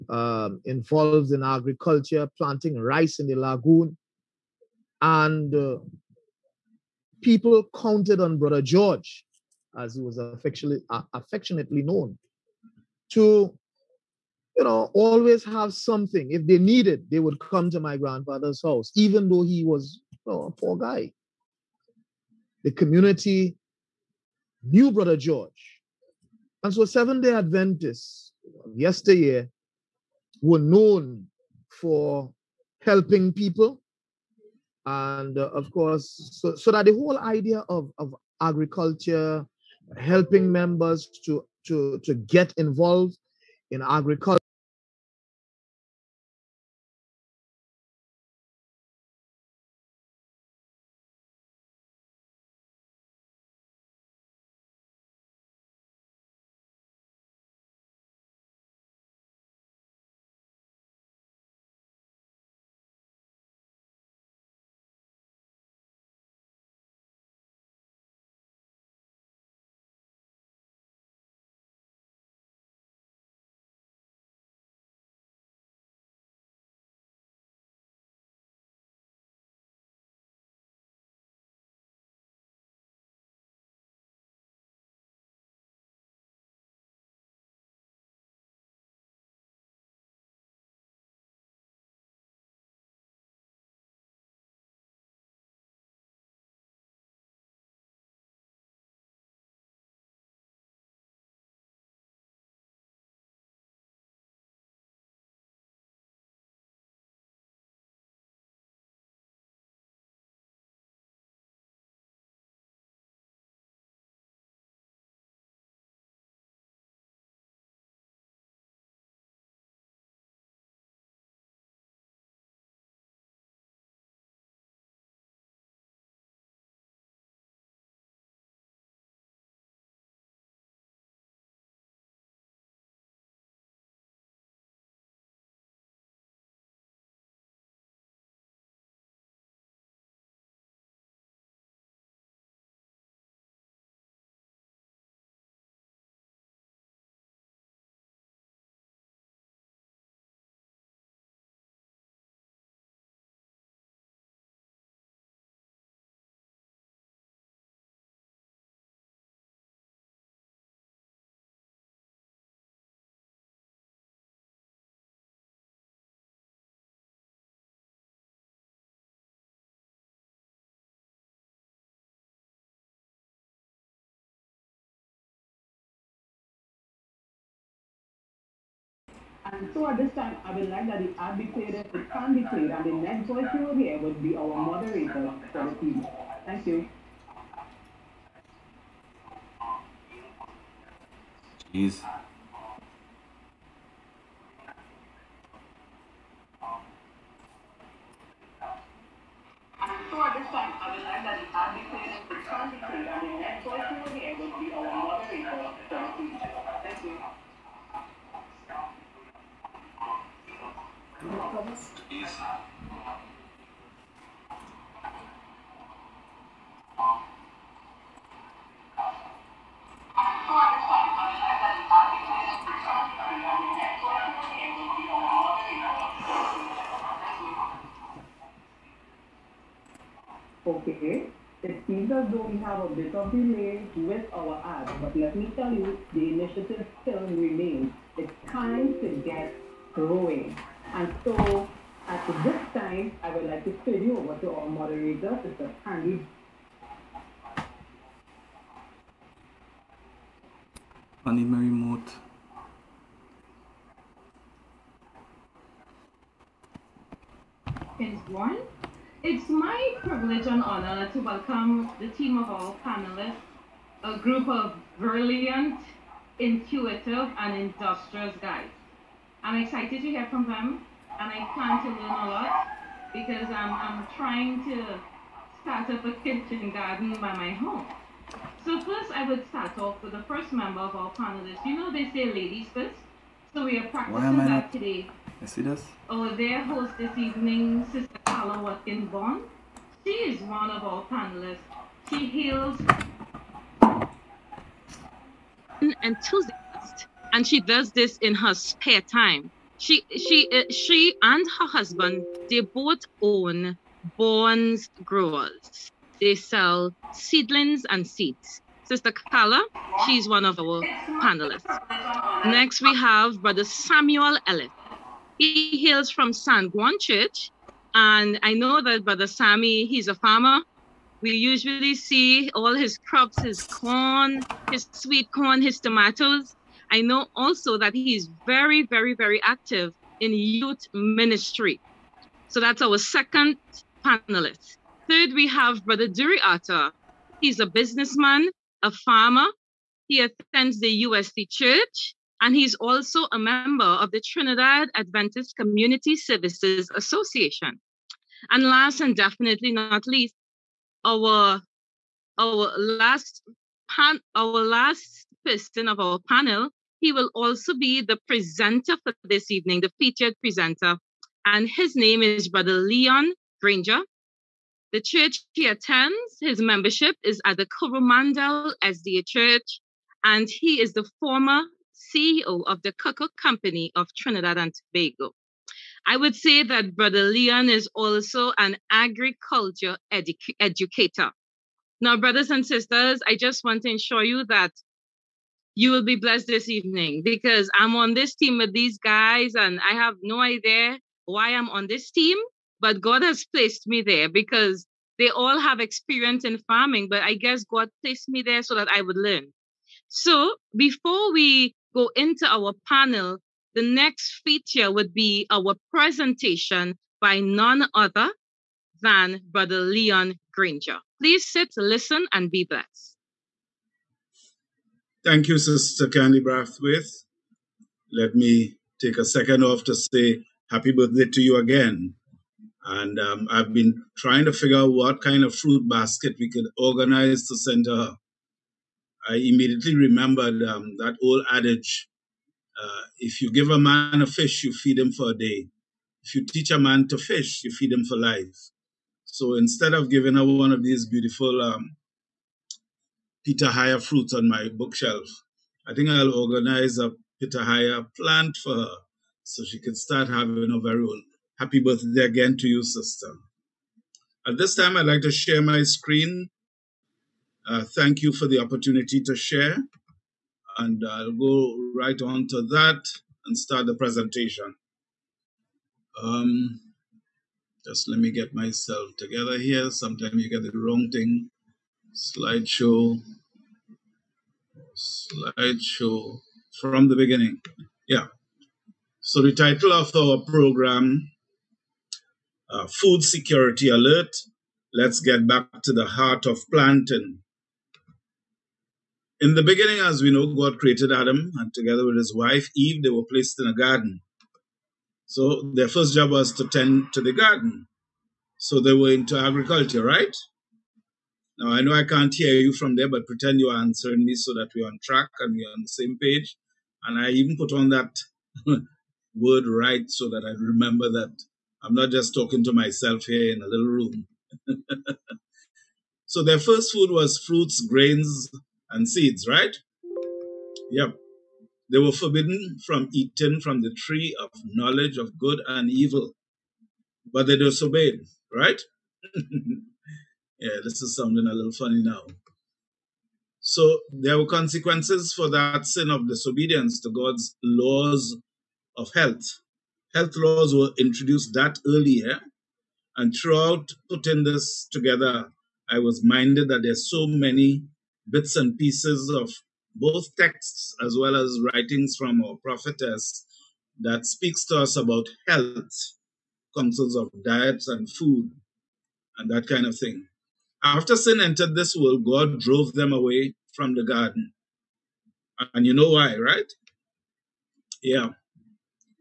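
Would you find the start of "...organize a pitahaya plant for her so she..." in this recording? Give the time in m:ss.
7:26.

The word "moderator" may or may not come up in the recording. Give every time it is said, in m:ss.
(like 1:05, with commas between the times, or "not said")
3:04, 4:04.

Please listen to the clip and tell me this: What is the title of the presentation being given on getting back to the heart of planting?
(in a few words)
Food Security Alert.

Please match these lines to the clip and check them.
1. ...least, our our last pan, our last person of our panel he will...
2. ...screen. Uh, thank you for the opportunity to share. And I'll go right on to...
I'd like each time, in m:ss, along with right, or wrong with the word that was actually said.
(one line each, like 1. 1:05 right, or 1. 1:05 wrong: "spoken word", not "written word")
1. 5:50 right
2. 7:35 right.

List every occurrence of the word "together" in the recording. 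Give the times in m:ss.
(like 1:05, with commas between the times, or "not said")
7:49, 8:11, 9:04.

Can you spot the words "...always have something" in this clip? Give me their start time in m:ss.
0:14.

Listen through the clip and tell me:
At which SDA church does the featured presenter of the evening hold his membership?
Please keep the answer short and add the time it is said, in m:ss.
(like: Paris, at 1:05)
Coromandel SDA Church, at 6:07.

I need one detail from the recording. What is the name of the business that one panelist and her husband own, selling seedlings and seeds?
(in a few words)
Borns Growers.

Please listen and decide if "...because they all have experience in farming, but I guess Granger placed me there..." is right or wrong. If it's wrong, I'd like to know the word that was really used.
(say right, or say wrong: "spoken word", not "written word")
wrong: "God", not "Granger".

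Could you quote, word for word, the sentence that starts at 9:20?
After sin entered this world, God drove them away from the garden.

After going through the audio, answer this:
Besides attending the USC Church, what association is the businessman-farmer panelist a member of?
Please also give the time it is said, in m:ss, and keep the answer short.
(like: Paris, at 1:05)
Trinidad Adventist Community Services Association, at 5:44.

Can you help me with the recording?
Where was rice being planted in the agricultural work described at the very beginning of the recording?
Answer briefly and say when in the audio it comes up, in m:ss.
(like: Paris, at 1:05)
the lagoon, at 0:03.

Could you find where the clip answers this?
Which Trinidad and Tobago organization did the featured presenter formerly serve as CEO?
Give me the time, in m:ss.
6:12.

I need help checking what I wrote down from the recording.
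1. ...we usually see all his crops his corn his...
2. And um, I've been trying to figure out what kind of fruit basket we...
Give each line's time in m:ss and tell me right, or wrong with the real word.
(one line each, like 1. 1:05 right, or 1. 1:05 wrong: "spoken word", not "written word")
1. 5:21 right
2. 7:02 right.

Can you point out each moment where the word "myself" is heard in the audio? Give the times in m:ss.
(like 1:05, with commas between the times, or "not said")
7:48, 8:32.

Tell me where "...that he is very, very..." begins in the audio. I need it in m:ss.
5:27.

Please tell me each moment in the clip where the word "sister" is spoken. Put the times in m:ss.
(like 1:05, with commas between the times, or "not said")
4:47, 5:08, 6:22, 6:55, 7:32.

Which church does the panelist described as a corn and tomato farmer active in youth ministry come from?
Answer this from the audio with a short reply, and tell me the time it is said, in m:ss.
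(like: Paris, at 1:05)
San Juan Church, at 5:16.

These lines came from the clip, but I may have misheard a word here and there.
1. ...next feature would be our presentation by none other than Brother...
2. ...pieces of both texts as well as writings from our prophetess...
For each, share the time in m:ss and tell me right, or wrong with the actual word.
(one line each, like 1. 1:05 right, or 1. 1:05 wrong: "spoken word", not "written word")
1. 6:43 right
2. 9:08 right.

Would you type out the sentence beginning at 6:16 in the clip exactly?
I would say that Brother Leon is also an agriculture edu- educator.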